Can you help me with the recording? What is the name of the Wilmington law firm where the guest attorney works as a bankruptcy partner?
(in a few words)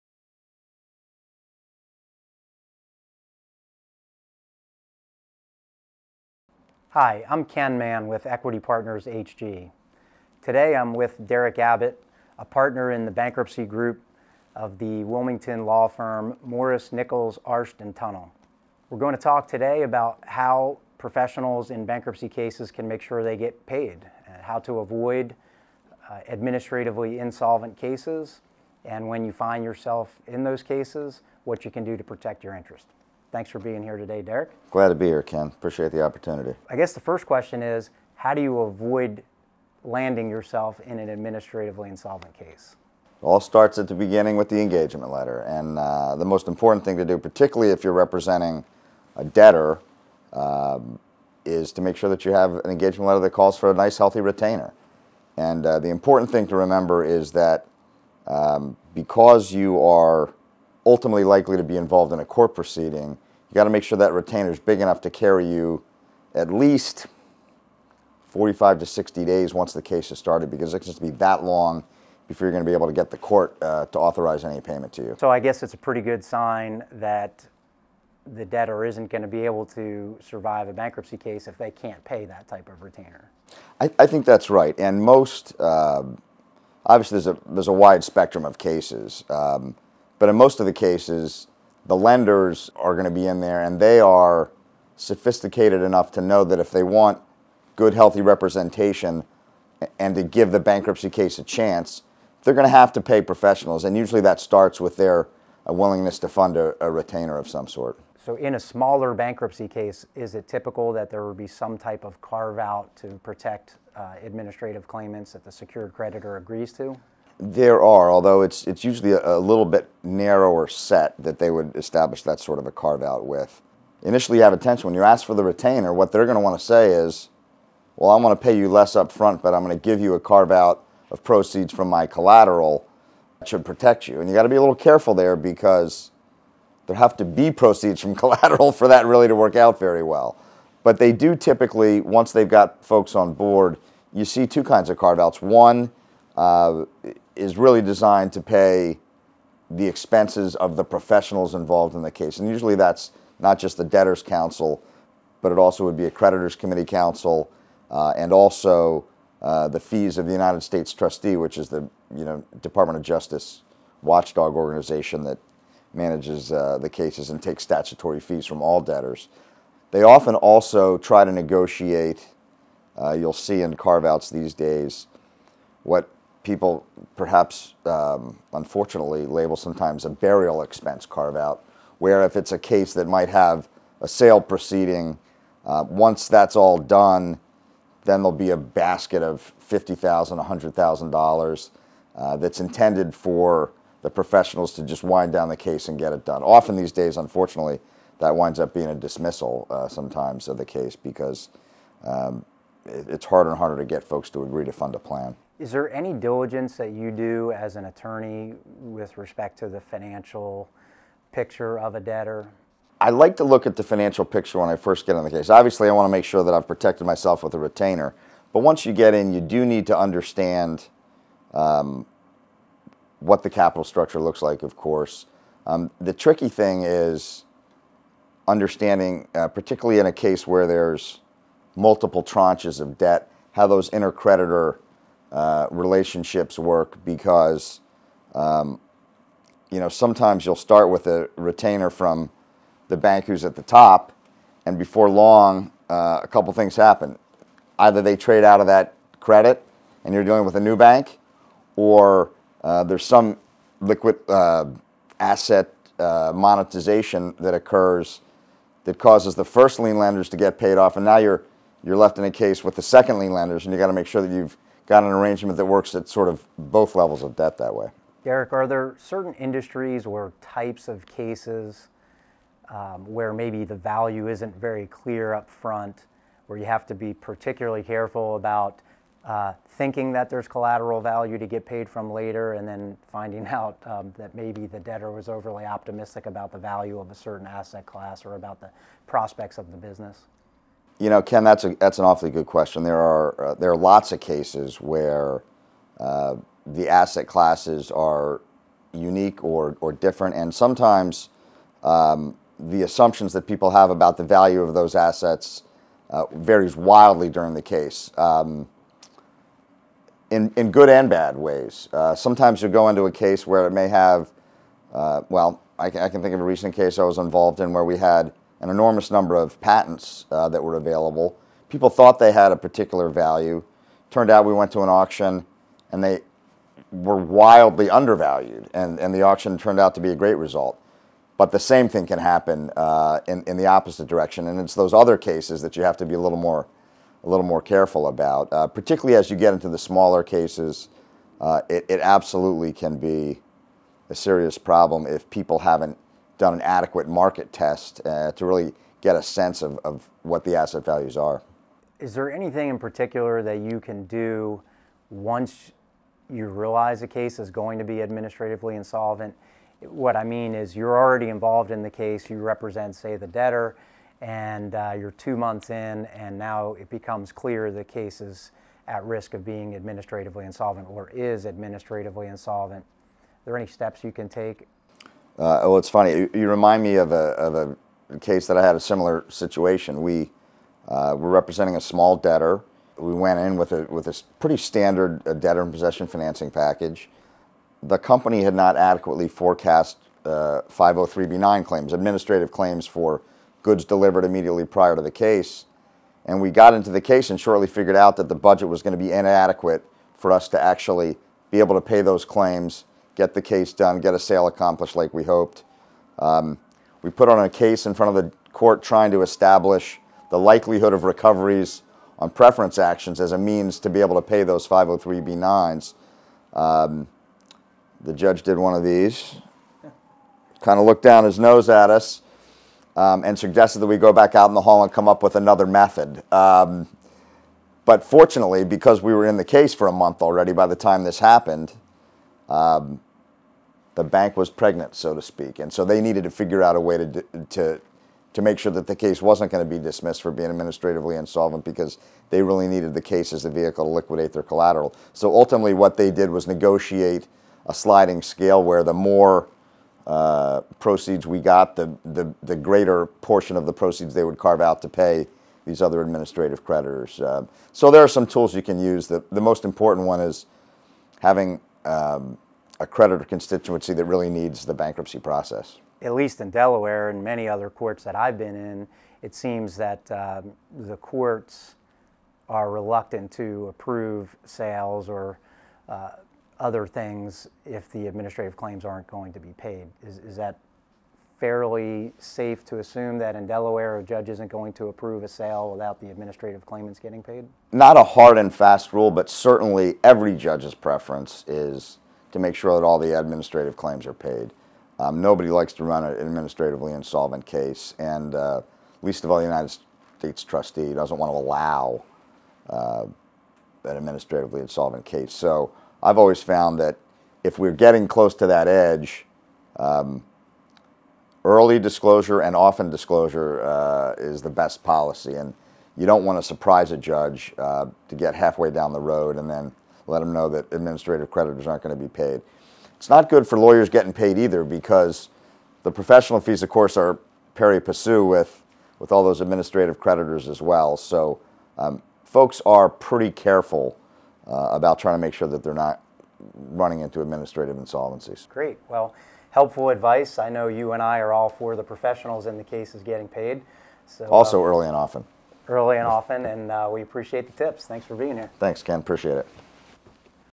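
Morris Nichols Arsht Tunnell.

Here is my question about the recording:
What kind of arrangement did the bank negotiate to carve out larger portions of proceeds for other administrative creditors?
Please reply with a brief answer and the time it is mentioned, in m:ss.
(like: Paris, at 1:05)
sliding scale, at 7:27.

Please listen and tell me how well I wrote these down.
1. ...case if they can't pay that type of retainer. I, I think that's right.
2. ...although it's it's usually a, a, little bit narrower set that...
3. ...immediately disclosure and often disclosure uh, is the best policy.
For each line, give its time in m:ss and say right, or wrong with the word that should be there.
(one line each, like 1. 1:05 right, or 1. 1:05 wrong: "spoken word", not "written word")
1. 1:21 right
2. 1:58 right
3. 8:31 wrong: "early", not "immediately".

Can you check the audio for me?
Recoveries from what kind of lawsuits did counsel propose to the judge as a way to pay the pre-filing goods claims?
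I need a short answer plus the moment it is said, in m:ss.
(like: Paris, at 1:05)
preference actions, at 6:52.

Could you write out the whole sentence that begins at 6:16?
You, you remind me of a, of a case that I had a similar situation.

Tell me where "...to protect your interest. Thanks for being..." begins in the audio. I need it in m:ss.
0:31.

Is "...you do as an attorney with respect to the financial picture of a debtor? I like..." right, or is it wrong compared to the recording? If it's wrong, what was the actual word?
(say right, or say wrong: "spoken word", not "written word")
right.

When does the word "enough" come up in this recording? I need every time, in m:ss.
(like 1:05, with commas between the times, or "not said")
1:04, 1:35.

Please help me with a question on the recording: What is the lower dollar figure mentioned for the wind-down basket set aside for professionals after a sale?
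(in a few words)
$50,000.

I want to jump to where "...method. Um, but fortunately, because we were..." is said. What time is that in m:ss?
7:05.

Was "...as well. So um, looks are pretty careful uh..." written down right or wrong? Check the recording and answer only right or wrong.
wrong.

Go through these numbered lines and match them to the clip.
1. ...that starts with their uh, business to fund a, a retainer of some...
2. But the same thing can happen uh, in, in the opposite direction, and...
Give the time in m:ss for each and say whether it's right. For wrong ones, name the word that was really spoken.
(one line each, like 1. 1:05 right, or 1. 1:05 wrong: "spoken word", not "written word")
1. 1:44 wrong: "willingness", not "business"
2. 5:31 right.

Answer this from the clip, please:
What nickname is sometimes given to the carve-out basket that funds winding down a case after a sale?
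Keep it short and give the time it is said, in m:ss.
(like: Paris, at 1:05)
burial expense carve out, at 3:00.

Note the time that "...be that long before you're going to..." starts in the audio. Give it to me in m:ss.
1:11.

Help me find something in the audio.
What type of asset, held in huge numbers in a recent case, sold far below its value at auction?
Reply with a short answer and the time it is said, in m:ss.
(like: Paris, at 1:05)
patents, at 5:19.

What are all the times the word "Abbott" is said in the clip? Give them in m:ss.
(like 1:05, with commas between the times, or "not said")
0:11.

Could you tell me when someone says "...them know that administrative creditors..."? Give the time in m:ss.
8:40.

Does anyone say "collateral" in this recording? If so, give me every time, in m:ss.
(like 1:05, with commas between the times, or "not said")
2:12, 2:18, 4:40, 7:24.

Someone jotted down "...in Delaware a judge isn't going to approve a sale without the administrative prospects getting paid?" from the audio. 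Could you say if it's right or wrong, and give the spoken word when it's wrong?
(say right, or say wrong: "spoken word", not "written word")
wrong: "claimants", not "prospects".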